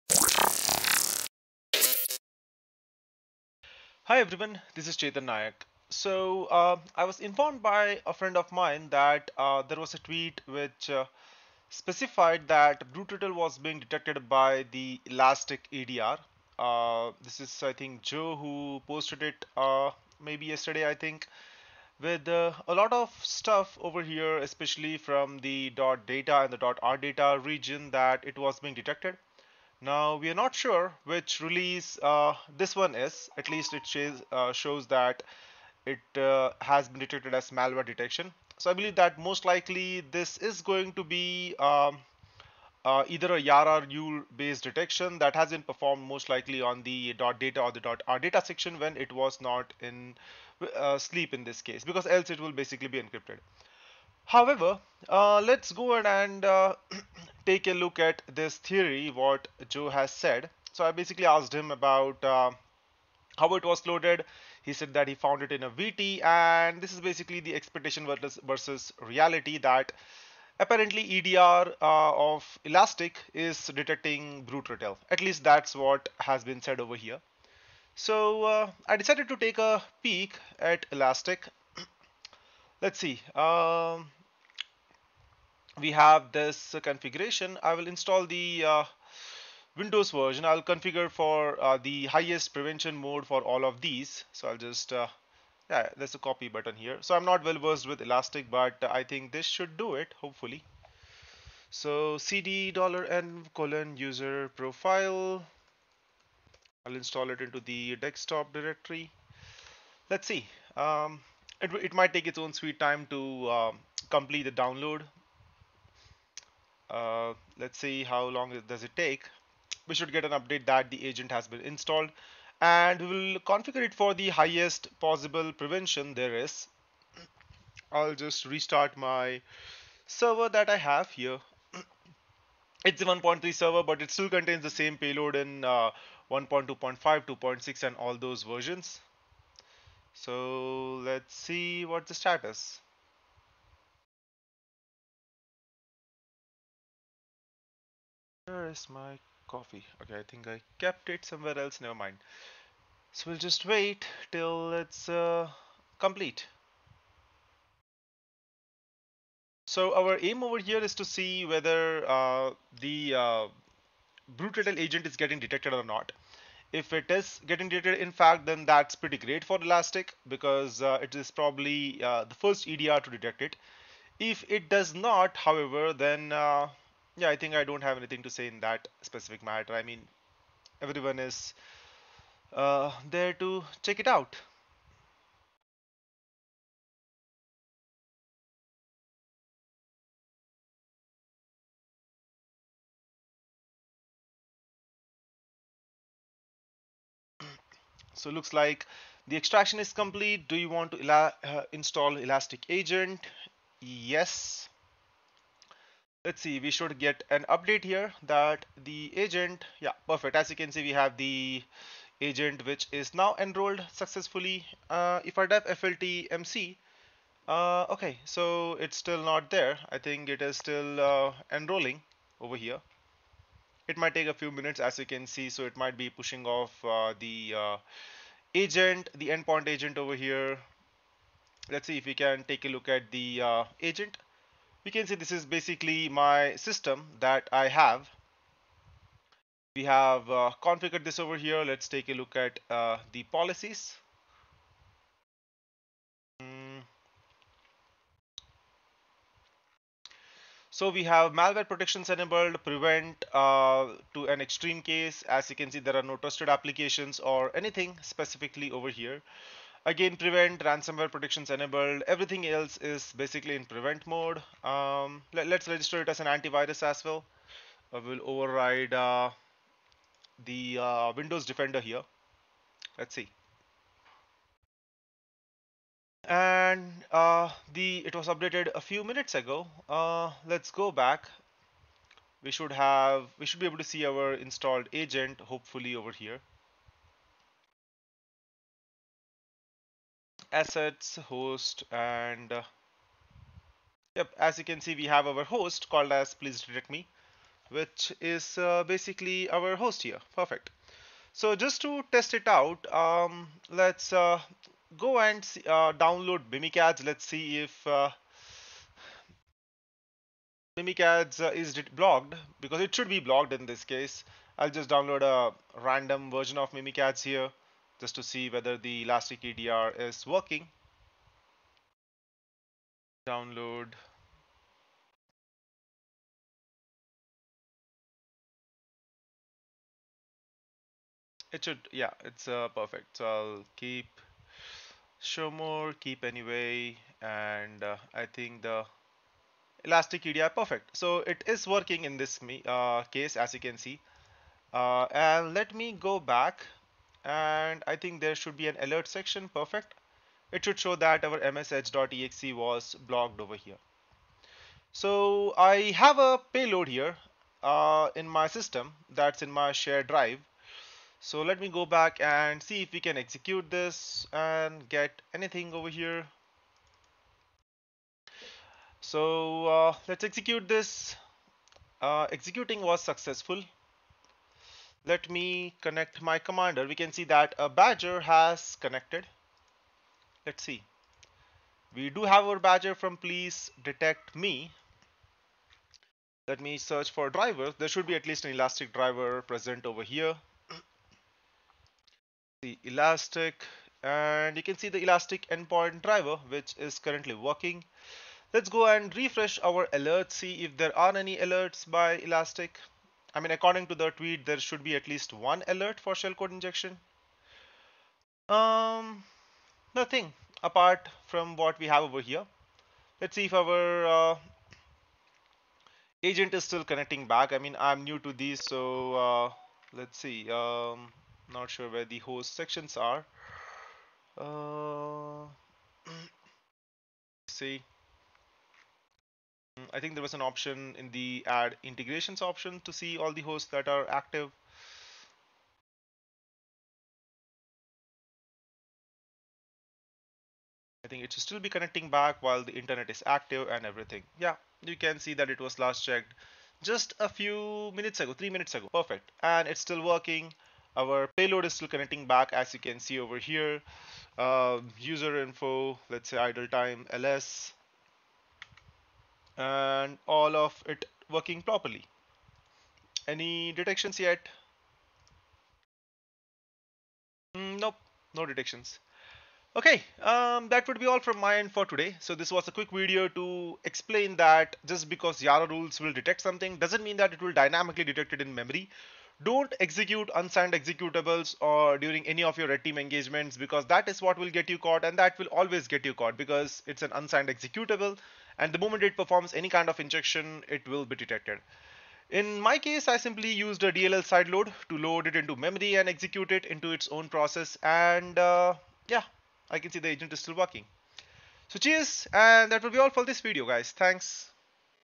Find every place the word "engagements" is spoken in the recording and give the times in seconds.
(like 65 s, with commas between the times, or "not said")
482 s.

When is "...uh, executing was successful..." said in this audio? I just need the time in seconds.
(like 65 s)
372 s.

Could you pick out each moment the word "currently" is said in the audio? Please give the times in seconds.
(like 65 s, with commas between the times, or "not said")
396 s.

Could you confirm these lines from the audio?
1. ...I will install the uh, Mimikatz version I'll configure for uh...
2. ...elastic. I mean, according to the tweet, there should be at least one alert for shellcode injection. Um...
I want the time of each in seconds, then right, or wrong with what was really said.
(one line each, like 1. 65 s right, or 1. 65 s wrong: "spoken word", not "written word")
1. 87 s wrong: "Windows", not "Mimikatz"
2. 402 s right.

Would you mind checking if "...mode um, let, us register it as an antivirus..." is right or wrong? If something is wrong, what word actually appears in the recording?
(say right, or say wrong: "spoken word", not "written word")
right.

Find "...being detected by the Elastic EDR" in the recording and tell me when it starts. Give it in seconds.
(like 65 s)
13 s.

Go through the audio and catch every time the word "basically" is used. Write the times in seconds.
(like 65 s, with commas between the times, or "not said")
52 s, 60 s, 67 s, 235 s, 263 s, 298 s.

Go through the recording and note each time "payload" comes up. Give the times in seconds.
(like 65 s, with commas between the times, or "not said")
134 s, 356 s, 451 s.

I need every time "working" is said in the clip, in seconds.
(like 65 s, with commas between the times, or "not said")
320 s, 341 s, 397 s, 450 s, 461 s, 500 s.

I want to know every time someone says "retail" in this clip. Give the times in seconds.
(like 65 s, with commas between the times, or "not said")
74 s.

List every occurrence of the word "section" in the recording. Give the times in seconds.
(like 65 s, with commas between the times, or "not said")
48 s, 349 s, 422 s.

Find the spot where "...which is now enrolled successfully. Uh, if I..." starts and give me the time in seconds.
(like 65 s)
212 s.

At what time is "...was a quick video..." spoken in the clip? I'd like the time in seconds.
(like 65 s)
472 s.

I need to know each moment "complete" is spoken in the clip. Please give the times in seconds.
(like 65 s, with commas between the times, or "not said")
114 s, 155 s, 199 s.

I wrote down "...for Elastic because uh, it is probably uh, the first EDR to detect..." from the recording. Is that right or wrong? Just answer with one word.
right.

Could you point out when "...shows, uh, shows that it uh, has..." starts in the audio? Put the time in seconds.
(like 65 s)
33 s.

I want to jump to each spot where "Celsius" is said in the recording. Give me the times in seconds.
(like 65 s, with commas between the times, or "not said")
not said.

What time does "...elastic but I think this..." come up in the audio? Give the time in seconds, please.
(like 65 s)
98 s.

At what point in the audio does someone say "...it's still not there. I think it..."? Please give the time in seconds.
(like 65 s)
218 s.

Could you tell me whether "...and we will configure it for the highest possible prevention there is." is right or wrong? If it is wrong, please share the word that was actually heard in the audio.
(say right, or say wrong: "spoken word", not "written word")
right.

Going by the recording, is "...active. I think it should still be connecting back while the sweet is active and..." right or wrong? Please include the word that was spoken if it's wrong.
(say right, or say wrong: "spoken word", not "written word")
wrong: "internet", not "sweet".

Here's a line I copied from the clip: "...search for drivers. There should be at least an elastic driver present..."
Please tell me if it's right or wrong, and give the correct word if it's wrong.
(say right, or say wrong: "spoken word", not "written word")
right.